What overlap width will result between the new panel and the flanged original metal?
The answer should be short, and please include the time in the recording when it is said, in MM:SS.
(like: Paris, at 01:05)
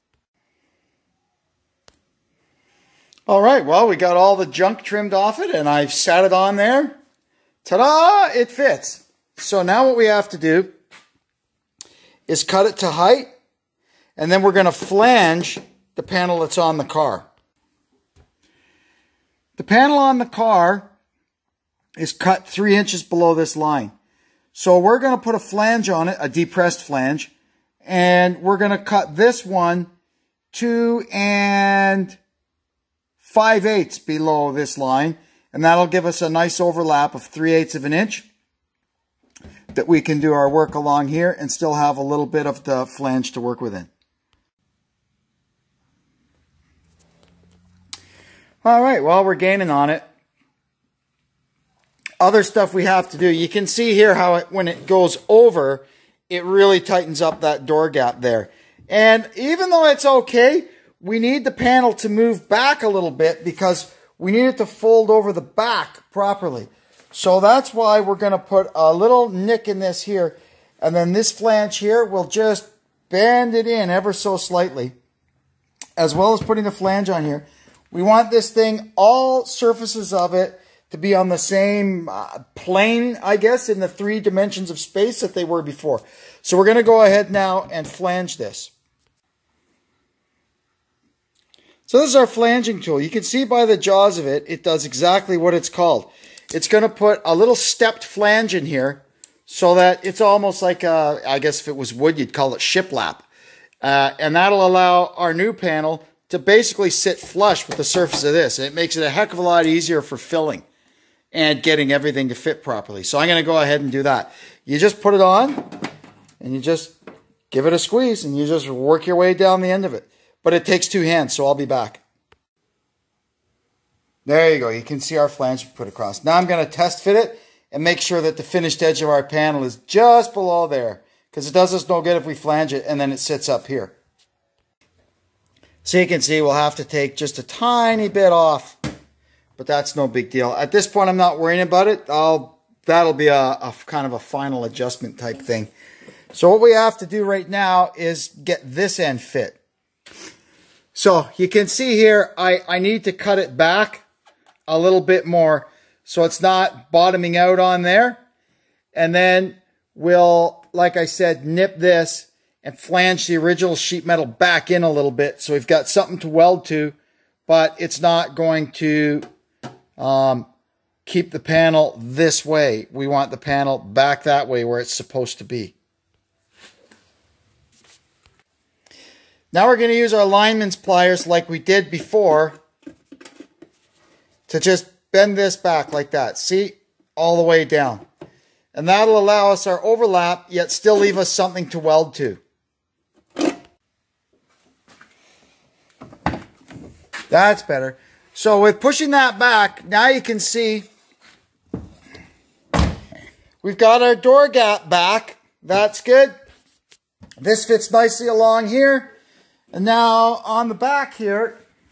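3/8 inch, at 00:37.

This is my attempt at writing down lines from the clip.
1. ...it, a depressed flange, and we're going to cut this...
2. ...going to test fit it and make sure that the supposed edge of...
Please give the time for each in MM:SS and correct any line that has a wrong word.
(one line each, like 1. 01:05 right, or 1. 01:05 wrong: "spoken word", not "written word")
1. 00:26 right
2. 02:06 wrong: "finished", not "supposed".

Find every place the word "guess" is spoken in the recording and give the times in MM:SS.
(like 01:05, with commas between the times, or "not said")
01:23, 01:41.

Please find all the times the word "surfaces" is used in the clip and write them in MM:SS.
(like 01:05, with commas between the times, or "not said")
01:19, 01:47.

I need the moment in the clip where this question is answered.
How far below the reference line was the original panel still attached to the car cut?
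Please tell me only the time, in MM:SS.
00:22.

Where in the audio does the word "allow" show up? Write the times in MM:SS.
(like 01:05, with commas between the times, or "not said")
01:44, 03:09.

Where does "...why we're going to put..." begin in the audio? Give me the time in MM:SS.
01:07.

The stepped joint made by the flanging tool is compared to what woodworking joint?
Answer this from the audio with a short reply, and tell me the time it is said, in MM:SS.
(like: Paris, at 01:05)
shiplap, at 01:42.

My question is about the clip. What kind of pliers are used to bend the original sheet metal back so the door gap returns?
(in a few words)
lineman's pliers.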